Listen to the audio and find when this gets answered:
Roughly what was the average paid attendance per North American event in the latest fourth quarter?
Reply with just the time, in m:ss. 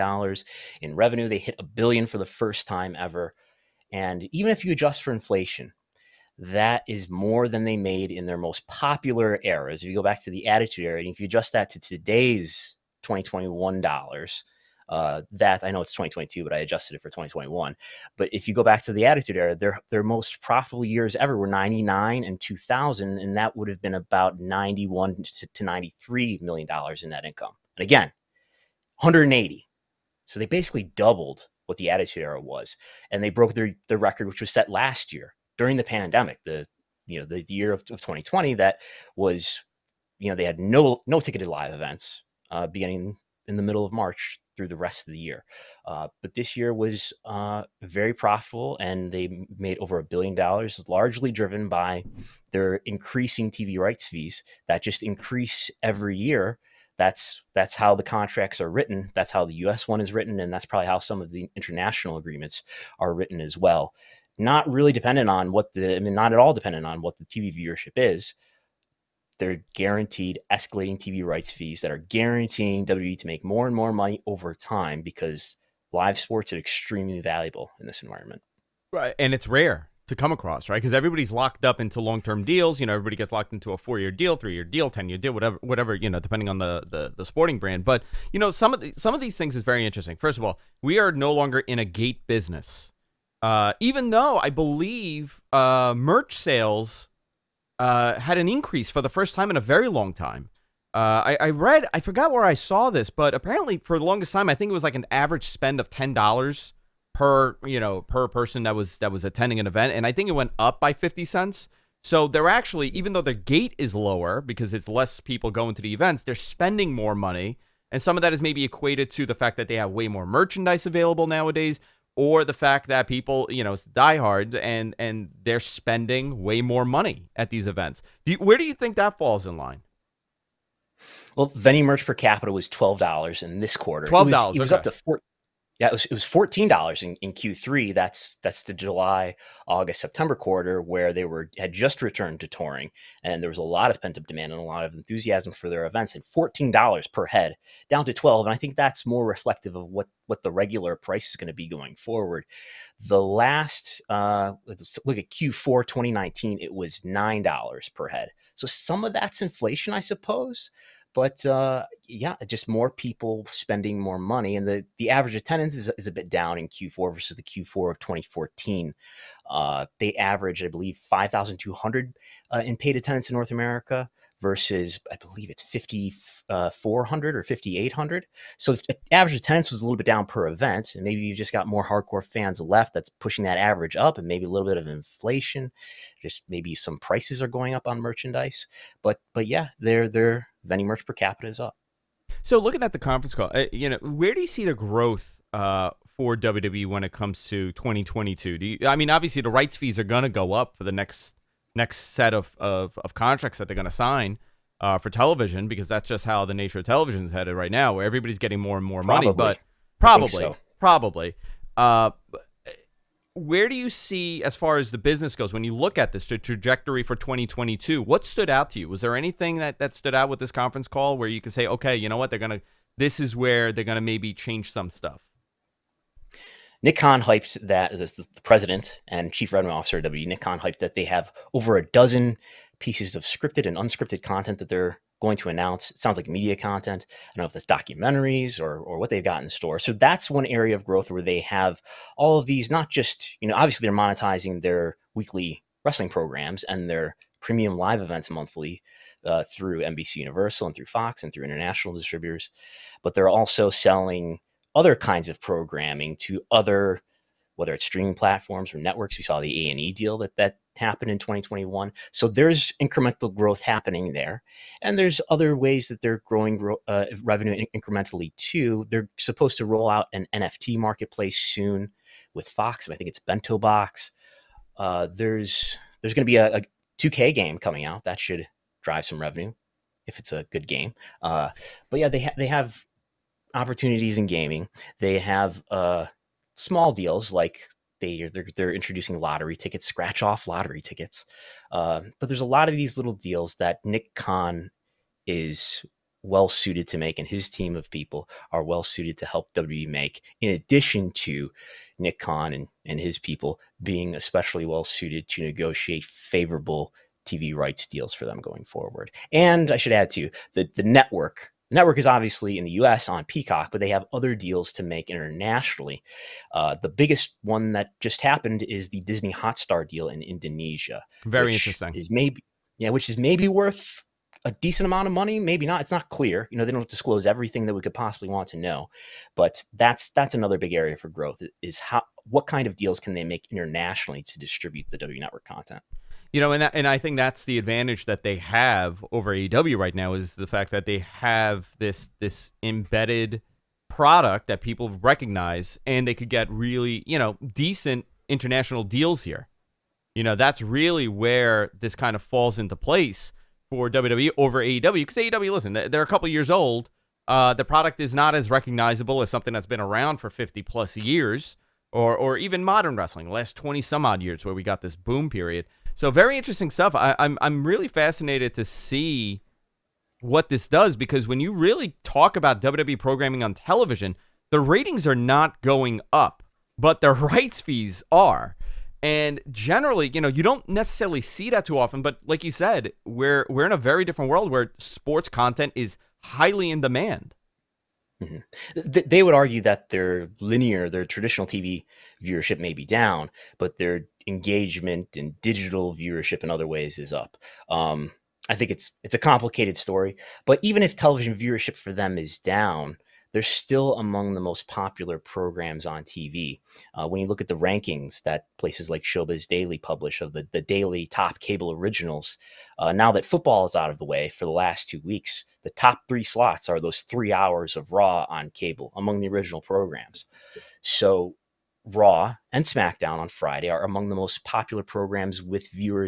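2:50.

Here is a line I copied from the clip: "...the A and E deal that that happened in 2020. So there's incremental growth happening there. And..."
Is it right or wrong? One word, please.
wrong.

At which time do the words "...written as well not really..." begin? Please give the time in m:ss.
1:03.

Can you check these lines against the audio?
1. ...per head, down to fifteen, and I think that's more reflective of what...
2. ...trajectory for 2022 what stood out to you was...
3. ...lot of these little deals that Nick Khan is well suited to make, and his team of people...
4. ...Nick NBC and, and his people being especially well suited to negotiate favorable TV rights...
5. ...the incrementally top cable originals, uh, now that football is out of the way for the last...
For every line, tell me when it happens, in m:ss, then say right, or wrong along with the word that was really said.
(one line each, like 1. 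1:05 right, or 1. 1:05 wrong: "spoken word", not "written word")
1. 2:27 wrong: "twelve", not "fifteen"
2. 3:36 right
3. 4:52 right
4. 5:01 wrong: "Khan", not "NBC"
5. 6:50 wrong: "daily", not "incrementally".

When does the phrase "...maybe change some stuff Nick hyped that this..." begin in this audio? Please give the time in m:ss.
3:43.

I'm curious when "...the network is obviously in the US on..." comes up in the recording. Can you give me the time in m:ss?
5:11.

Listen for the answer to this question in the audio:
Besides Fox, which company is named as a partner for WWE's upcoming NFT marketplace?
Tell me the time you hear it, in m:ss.
4:33.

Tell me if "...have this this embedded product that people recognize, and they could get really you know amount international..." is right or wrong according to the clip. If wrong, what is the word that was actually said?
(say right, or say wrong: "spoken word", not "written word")
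wrong: "decent", not "amount".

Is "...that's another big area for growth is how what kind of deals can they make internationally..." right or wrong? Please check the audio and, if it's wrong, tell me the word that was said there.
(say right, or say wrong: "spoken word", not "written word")
right.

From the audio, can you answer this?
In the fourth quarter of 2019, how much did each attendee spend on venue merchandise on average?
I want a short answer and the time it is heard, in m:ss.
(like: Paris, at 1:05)
$9, at 2:37.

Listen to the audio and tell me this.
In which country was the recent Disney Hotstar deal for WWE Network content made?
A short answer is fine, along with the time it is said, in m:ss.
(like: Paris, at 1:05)
Indonesia, at 5:20.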